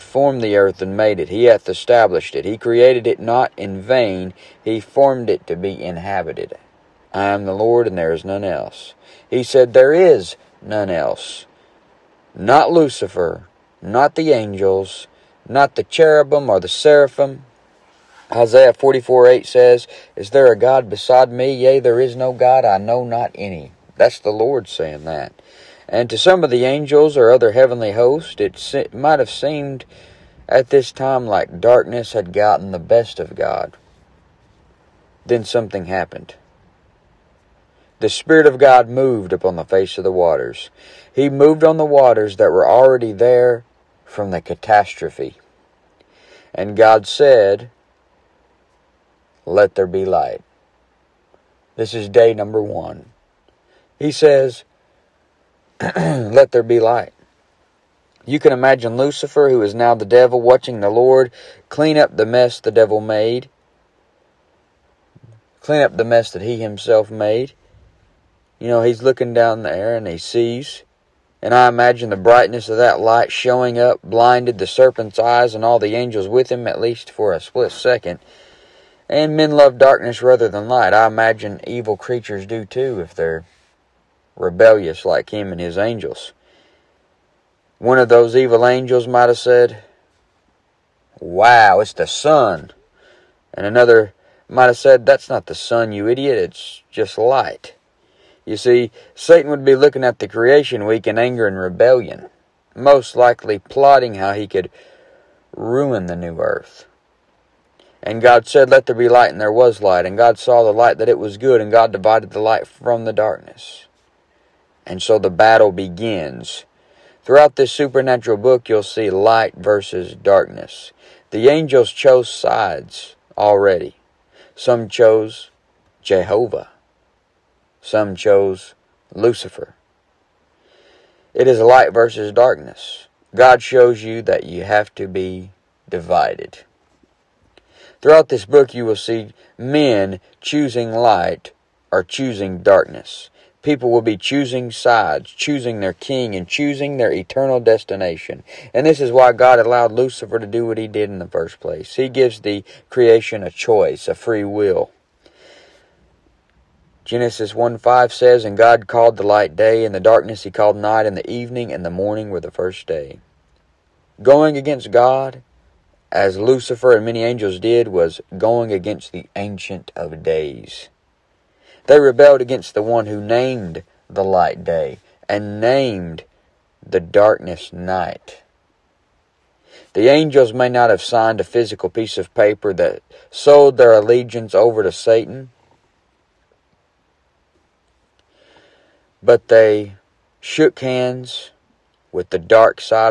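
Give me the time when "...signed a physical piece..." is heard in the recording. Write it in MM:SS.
03:01.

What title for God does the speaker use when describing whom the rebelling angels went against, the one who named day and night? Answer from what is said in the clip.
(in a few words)
Ancient of Days.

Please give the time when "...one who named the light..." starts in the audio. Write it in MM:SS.
02:52.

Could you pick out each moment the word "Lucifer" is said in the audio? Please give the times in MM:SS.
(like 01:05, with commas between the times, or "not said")
00:12, 00:58, 02:09, 02:29, 02:46.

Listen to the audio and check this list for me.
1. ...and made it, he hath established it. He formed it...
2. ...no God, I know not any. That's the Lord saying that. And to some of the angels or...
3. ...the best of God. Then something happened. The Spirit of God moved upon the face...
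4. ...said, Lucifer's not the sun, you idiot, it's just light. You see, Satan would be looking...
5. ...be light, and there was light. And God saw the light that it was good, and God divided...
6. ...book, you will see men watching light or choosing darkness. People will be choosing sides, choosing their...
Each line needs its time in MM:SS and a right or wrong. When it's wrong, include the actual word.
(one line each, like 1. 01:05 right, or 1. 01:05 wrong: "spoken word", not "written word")
1. 00:00 wrong: "created", not "formed"
2. 00:22 right
3. 00:32 right
4. 01:34 wrong: "That", not "Lucifer"
5. 01:48 right
6. 02:18 wrong: "choosing", not "watching".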